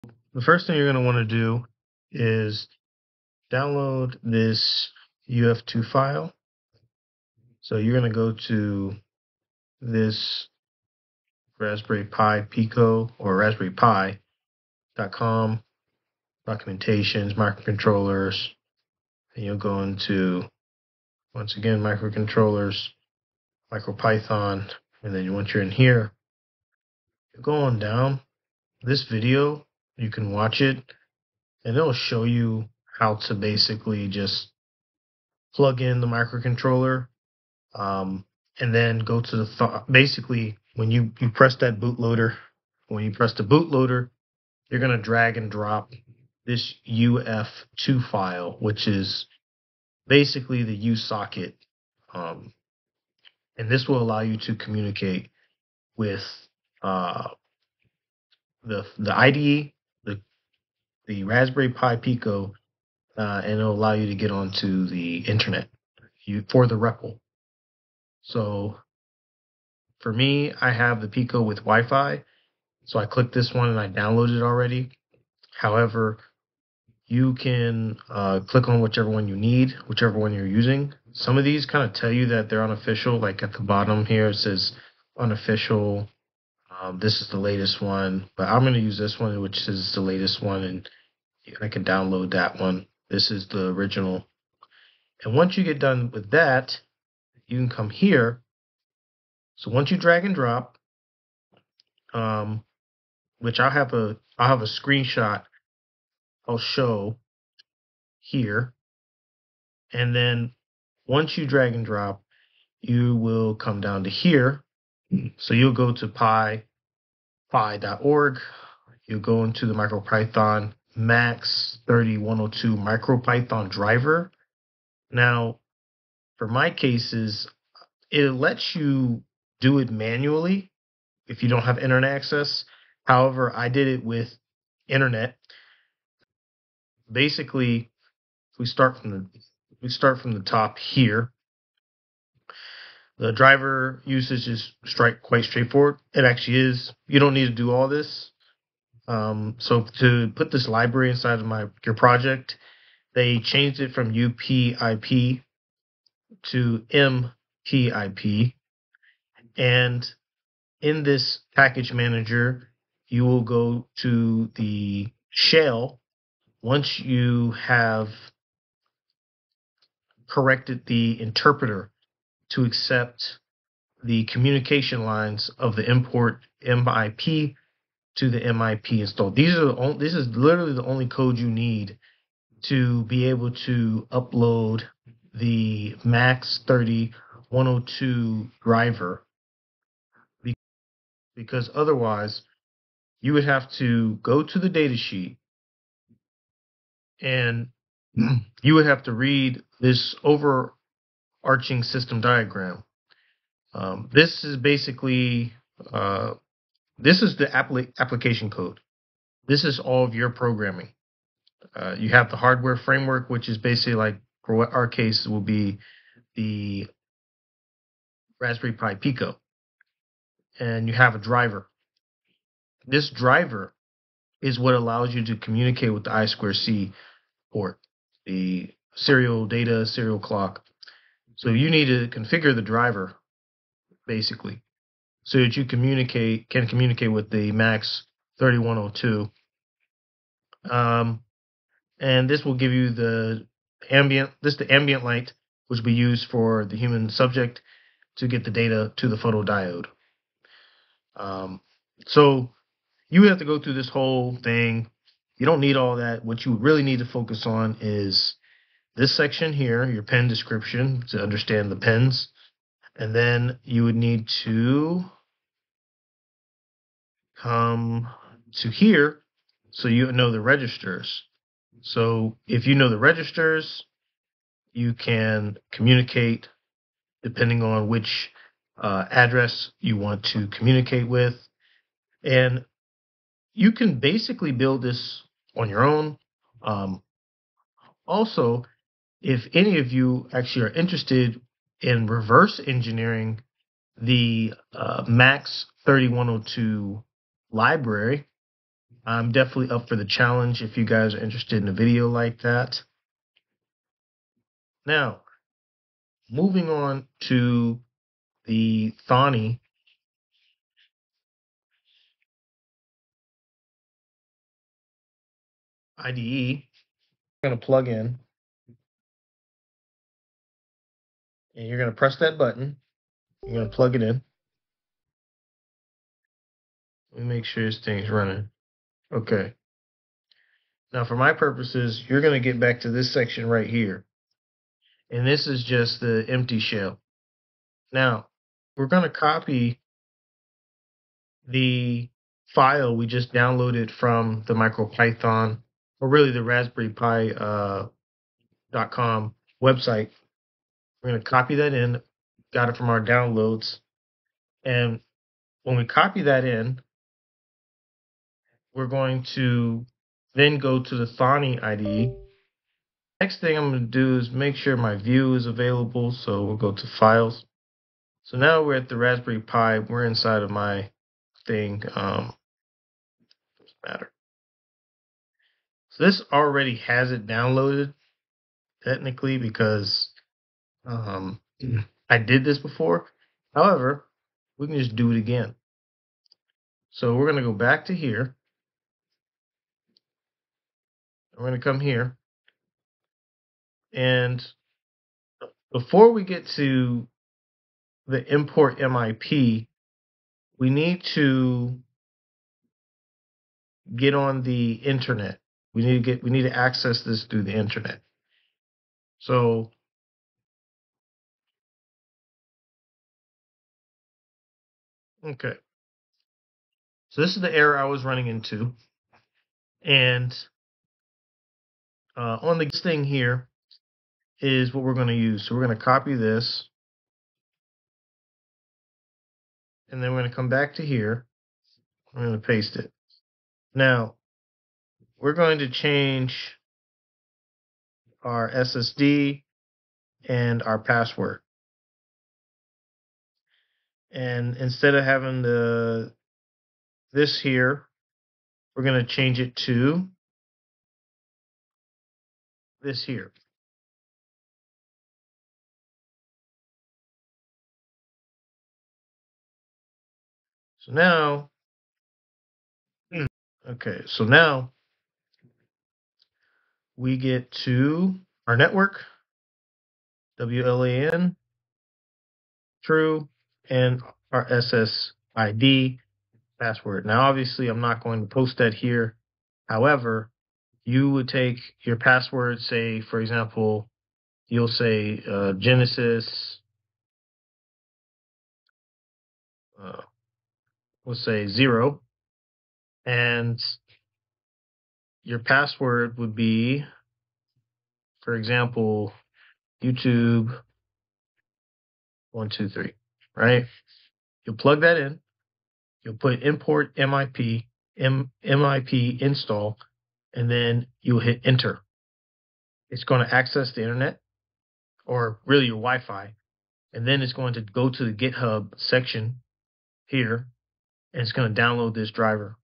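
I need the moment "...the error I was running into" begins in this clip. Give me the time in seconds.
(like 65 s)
417 s.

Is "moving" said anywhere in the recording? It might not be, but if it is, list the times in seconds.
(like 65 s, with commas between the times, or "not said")
306 s.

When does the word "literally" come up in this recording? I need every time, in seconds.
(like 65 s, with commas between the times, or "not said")
180 s.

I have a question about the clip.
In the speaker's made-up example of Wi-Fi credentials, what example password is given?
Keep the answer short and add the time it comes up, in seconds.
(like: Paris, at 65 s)
YouTube123, at 499 s.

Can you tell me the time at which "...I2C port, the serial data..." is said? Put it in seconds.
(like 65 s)
226 s.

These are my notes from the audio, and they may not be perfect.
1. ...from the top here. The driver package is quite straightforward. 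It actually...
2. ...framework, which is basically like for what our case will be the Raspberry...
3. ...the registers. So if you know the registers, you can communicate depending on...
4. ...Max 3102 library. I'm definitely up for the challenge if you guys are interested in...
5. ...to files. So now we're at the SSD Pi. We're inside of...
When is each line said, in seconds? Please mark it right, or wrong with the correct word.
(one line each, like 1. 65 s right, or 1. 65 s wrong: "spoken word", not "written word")
1. 140 s wrong: "usage", not "package"
2. 212 s right
3. 270 s right
4. 295 s right
5. 366 s wrong: "Raspberry", not "SSD".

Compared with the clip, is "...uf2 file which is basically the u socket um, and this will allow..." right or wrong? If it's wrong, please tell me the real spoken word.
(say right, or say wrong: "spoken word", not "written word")
right.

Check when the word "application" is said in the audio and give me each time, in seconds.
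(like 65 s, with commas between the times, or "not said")
207 s.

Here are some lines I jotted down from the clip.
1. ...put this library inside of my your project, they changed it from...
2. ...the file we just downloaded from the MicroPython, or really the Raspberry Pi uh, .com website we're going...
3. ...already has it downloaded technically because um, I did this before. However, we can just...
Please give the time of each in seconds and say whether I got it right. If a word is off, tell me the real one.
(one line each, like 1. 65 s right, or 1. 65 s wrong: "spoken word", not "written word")
1. 150 s right
2. 341 s right
3. 376 s right.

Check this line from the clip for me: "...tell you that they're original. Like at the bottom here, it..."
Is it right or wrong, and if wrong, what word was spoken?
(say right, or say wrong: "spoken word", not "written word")
wrong: "unofficial", not "original".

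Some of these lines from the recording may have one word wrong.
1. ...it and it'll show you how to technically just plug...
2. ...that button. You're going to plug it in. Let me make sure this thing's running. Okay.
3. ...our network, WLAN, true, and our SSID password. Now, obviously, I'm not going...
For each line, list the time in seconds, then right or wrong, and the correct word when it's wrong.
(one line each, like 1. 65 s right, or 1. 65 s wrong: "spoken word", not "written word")
1. 30 s wrong: "basically", not "technically"
2. 322 s right
3. 468 s right.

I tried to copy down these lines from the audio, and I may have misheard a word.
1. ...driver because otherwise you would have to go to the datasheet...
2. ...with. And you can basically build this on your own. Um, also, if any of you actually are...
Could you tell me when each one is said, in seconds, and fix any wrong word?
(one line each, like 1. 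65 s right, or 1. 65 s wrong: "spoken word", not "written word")
1. 188 s right
2. 281 s right.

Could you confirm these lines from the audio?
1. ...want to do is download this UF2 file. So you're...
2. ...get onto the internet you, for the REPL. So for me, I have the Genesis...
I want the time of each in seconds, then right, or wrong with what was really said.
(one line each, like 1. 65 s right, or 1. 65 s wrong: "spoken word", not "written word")
1. 1 s right
2. 64 s wrong: "Pico", not "Genesis".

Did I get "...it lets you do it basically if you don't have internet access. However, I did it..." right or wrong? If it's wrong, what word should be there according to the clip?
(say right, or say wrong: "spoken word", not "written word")
wrong: "manually", not "basically".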